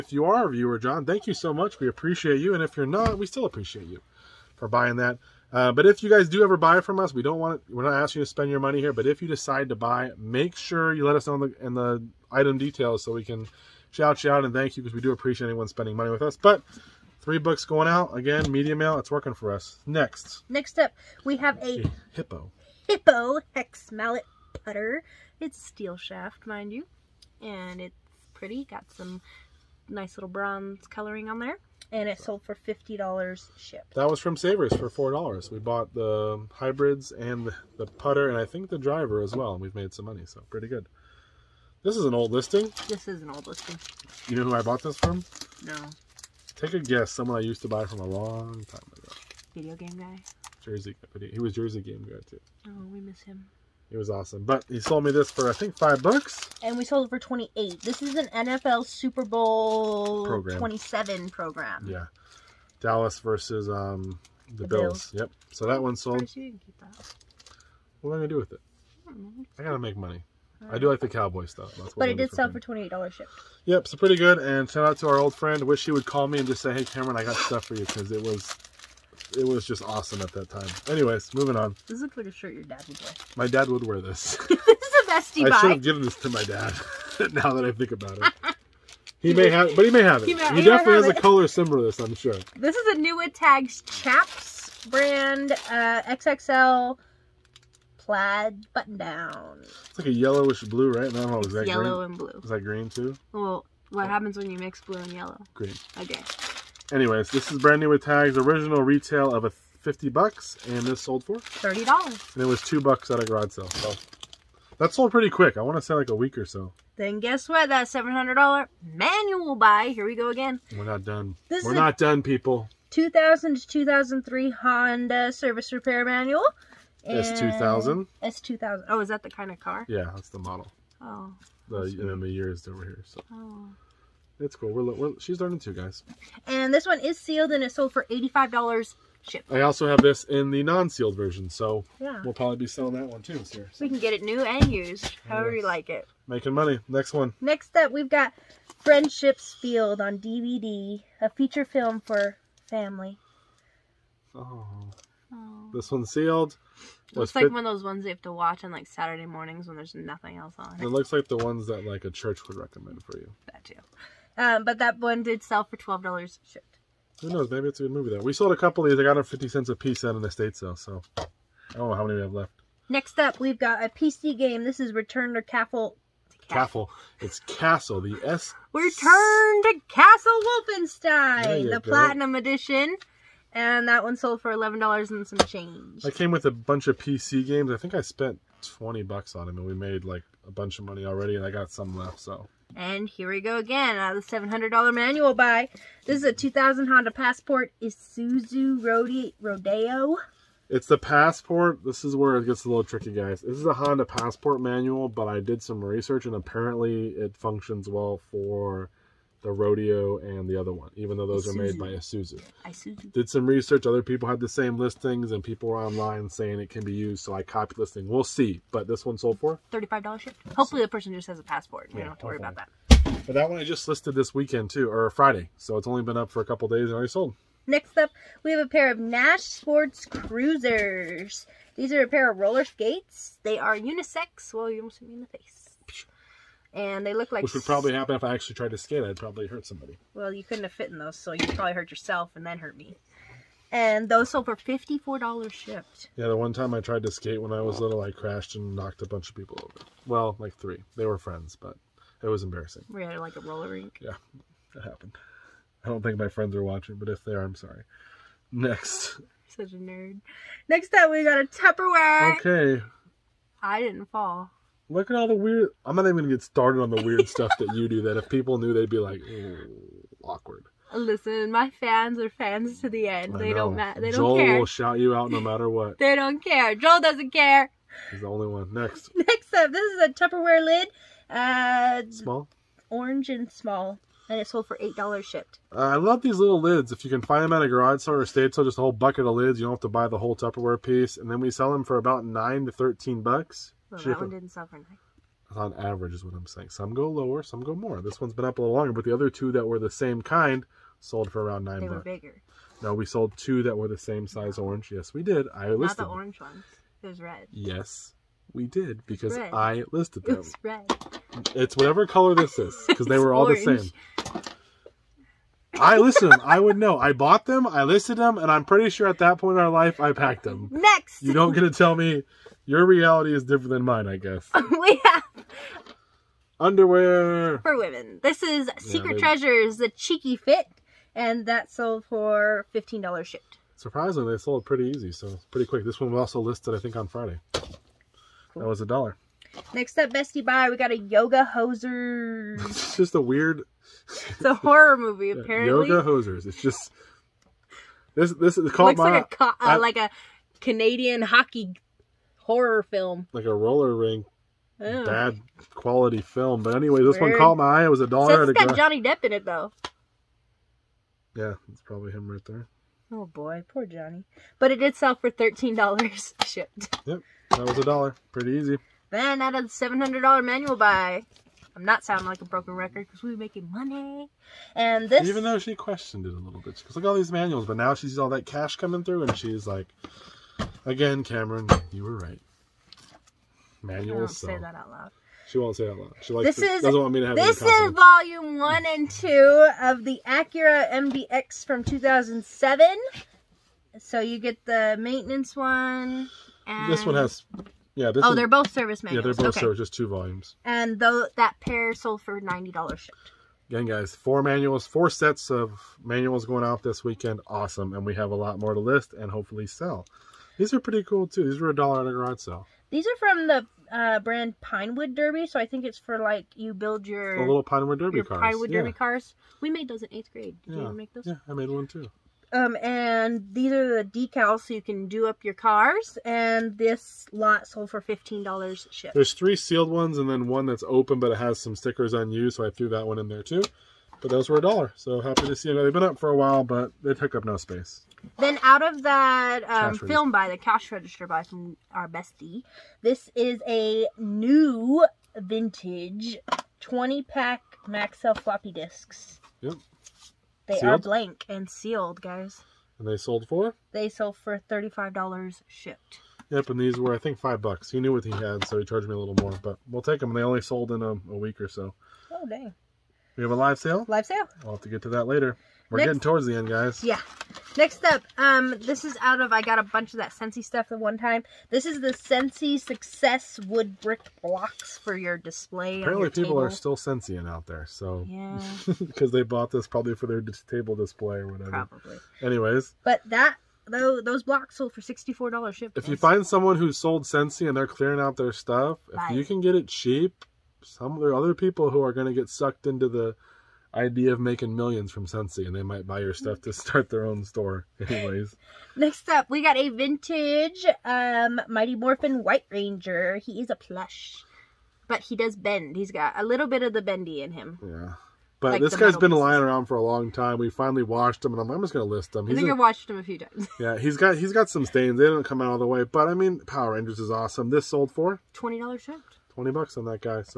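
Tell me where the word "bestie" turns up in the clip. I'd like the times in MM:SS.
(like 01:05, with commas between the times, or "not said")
01:25, 05:40, 07:22.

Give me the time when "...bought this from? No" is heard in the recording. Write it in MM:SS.
00:44.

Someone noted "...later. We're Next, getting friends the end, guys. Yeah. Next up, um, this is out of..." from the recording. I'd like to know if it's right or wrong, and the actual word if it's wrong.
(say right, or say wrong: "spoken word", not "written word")
wrong: "towards", not "friends".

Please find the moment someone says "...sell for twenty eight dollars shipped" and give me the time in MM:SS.
01:12.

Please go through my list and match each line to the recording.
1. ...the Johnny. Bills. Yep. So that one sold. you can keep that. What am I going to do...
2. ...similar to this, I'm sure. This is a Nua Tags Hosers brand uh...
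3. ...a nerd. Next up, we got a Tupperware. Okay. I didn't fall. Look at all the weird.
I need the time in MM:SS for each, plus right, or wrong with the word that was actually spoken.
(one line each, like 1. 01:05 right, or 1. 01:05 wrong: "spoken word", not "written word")
1. 01:04 wrong: "Bills", not "Johnny"
2. 01:31 wrong: "Chaps", not "Hosers"
3. 04:19 right.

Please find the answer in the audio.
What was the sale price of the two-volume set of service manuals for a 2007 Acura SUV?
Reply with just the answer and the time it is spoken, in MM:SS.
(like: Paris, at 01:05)
$90, at 06:42.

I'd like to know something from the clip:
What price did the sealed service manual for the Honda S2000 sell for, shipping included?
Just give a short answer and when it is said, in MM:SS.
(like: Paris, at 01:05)
$85, at 02:18.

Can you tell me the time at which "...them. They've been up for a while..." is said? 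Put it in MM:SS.
07:15.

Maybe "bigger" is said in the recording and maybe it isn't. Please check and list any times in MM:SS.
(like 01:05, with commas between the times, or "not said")
05:02.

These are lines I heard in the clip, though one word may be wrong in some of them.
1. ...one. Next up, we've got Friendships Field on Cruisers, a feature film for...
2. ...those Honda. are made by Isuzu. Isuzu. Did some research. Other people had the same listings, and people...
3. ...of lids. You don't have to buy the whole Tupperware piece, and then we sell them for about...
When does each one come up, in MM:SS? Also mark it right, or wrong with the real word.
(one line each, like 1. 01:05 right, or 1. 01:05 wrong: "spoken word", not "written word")
1. 02:27 wrong: "DVD", not "Cruisers"
2. 03:31 wrong: "Isuzu", not "Honda"
3. 04:49 right.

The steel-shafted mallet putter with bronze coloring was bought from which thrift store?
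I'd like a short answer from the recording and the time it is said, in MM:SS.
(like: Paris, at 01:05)
Savers, at 00:34.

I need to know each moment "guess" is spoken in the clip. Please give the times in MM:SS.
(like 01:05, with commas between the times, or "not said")
00:46, 01:57, 05:24.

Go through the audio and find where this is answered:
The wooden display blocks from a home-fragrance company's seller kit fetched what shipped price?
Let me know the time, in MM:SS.
08:05.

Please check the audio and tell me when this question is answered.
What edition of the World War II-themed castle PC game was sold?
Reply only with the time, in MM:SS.
03:01.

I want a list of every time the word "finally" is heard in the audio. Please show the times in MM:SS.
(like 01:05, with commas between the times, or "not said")
08:30.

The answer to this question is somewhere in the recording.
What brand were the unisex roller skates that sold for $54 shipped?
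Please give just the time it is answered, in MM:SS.
03:48.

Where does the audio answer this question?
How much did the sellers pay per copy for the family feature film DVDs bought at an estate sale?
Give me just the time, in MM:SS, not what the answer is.
02:49.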